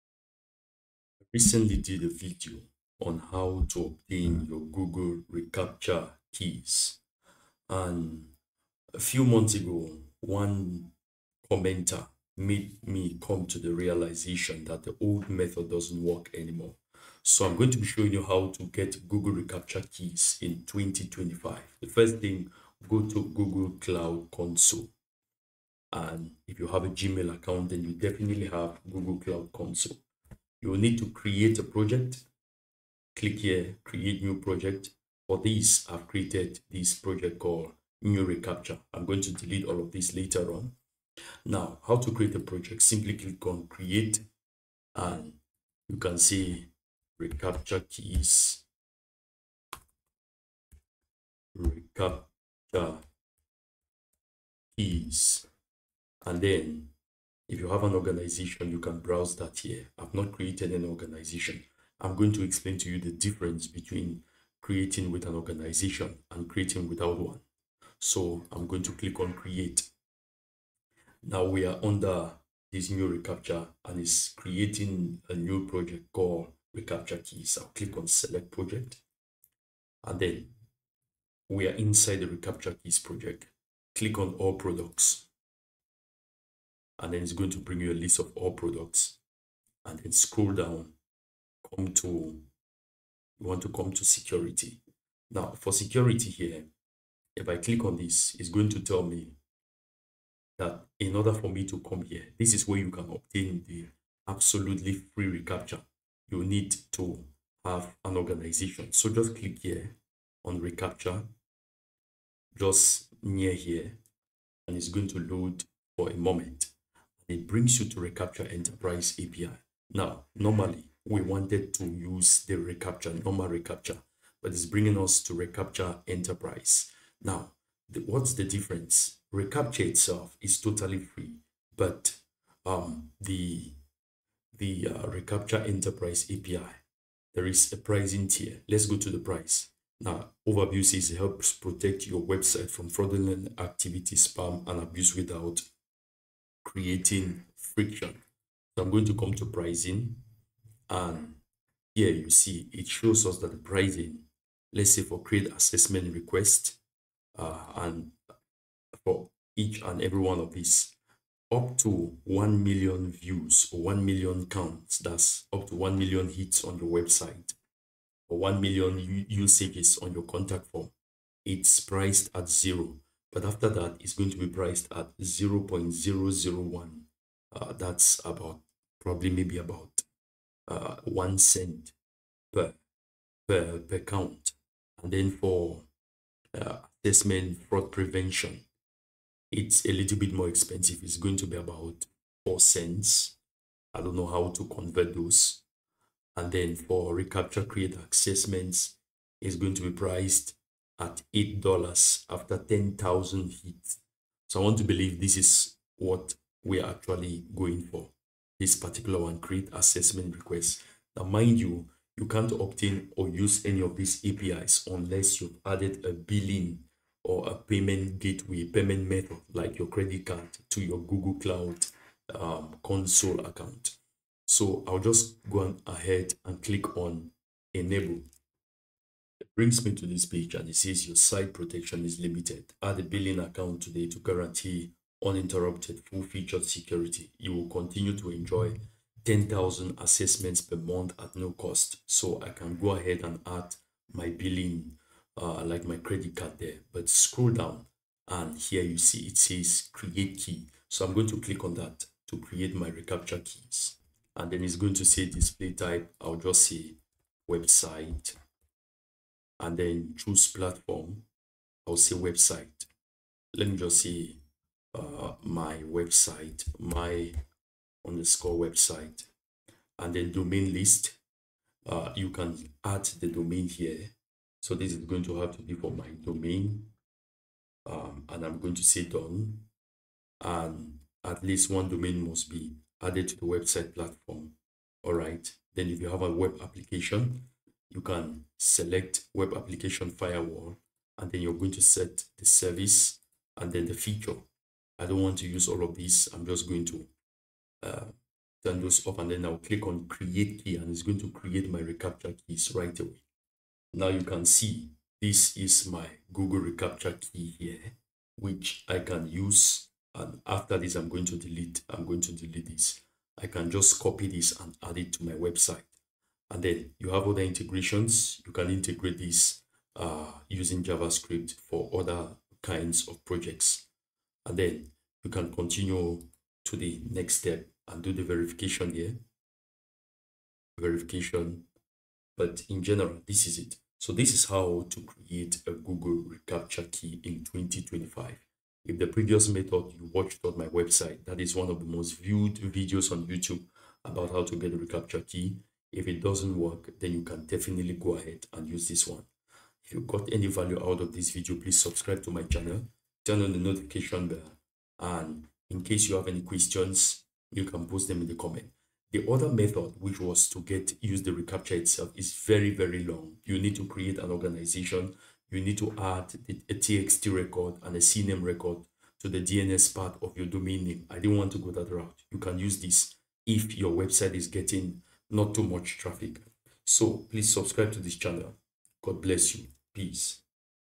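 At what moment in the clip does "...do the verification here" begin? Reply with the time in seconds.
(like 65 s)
328 s.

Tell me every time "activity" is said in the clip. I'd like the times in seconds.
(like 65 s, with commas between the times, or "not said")
143 s.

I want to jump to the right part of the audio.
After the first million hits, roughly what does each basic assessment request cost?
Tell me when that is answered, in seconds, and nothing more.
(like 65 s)
181 s.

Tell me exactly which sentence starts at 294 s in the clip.
I don't want to use all of these.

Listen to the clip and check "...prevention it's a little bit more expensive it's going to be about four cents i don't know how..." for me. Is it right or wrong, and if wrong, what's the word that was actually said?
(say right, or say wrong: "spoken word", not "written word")
right.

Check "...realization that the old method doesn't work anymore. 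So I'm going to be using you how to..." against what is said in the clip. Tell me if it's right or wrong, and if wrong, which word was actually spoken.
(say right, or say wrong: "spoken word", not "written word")
wrong: "showing", not "using".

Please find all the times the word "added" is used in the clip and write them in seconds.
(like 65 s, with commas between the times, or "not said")
215 s, 283 s.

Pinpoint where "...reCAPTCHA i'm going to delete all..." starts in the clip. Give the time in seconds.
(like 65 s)
38 s.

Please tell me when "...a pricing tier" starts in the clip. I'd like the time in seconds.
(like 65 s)
137 s.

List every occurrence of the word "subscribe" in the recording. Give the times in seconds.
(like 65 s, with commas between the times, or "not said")
351 s, 377 s.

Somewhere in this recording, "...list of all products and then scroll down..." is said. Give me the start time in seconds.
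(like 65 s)
87 s.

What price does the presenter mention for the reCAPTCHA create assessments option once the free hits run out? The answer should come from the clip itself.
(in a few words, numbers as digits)
$8.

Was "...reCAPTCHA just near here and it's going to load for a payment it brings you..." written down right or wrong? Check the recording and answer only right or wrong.
wrong.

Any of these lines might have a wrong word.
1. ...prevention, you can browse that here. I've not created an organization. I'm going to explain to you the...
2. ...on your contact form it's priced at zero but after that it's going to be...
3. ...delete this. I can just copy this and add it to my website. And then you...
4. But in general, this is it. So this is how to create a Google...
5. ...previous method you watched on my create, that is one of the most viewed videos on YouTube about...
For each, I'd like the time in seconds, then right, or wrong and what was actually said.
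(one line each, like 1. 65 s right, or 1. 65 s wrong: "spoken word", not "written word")
1. 57 s wrong: "organization", not "prevention"
2. 170 s right
3. 312 s right
4. 332 s right
5. 339 s wrong: "website", not "create".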